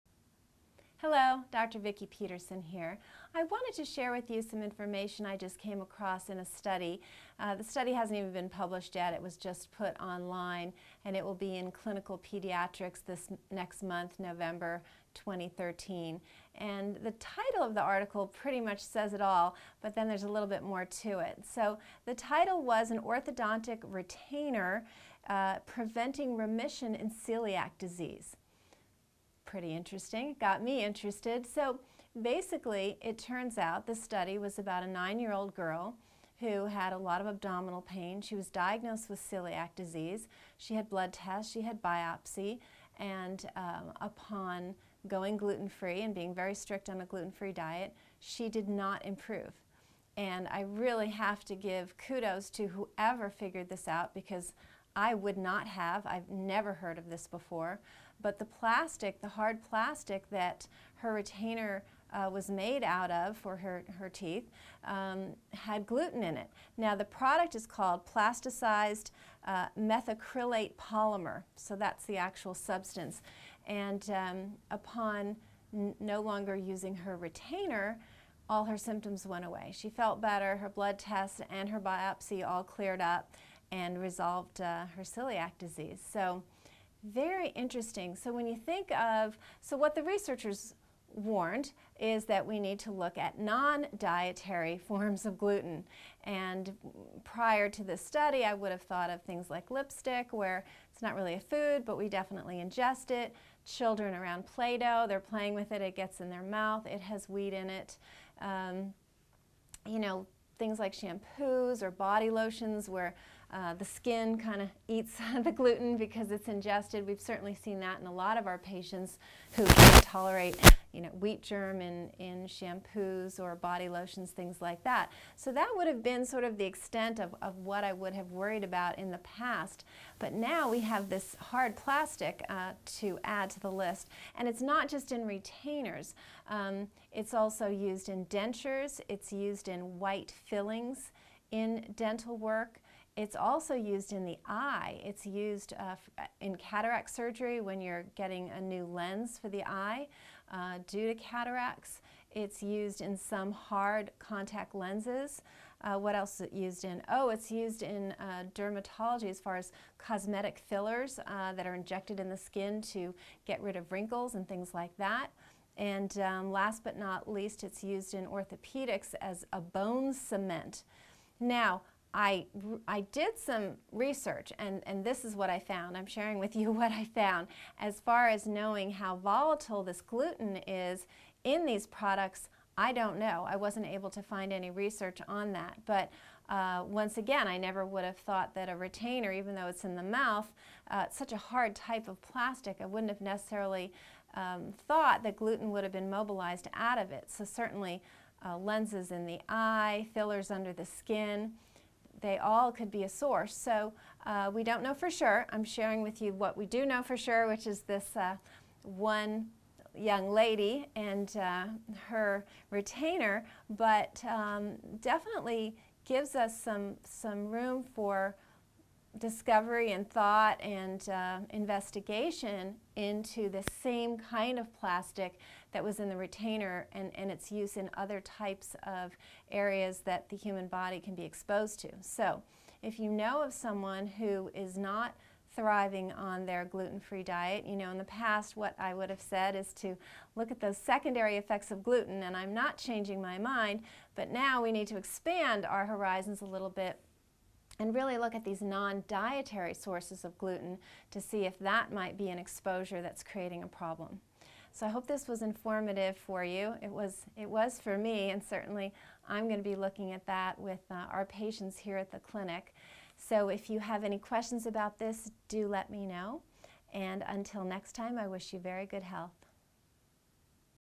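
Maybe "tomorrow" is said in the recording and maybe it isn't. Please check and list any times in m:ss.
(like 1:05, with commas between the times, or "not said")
not said.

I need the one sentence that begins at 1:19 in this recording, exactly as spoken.
She felt better, her blood tests and her biopsy all cleared up and resolved uh, her celiac disease.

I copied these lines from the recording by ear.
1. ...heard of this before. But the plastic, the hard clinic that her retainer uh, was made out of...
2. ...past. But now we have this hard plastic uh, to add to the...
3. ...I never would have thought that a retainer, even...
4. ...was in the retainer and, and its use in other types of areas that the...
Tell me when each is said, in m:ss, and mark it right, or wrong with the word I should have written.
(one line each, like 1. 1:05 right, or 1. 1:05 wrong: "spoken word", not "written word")
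1. 0:56 wrong: "plastic", not "clinic"
2. 2:09 right
3. 3:07 right
4. 3:45 right.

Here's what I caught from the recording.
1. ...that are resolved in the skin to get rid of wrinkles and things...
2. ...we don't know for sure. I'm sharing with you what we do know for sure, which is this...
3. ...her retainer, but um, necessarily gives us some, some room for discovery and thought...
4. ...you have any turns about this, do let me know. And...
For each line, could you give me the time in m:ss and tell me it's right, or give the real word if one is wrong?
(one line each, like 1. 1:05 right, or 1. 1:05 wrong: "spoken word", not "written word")
1. 2:41 wrong: "injected", not "resolved"
2. 3:24 right
3. 3:32 wrong: "definitely", not "necessarily"
4. 4:23 wrong: "questions", not "turns".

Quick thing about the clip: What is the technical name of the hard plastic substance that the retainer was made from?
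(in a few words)
methacrylate polymer.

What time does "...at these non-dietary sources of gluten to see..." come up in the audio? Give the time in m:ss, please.
4:08.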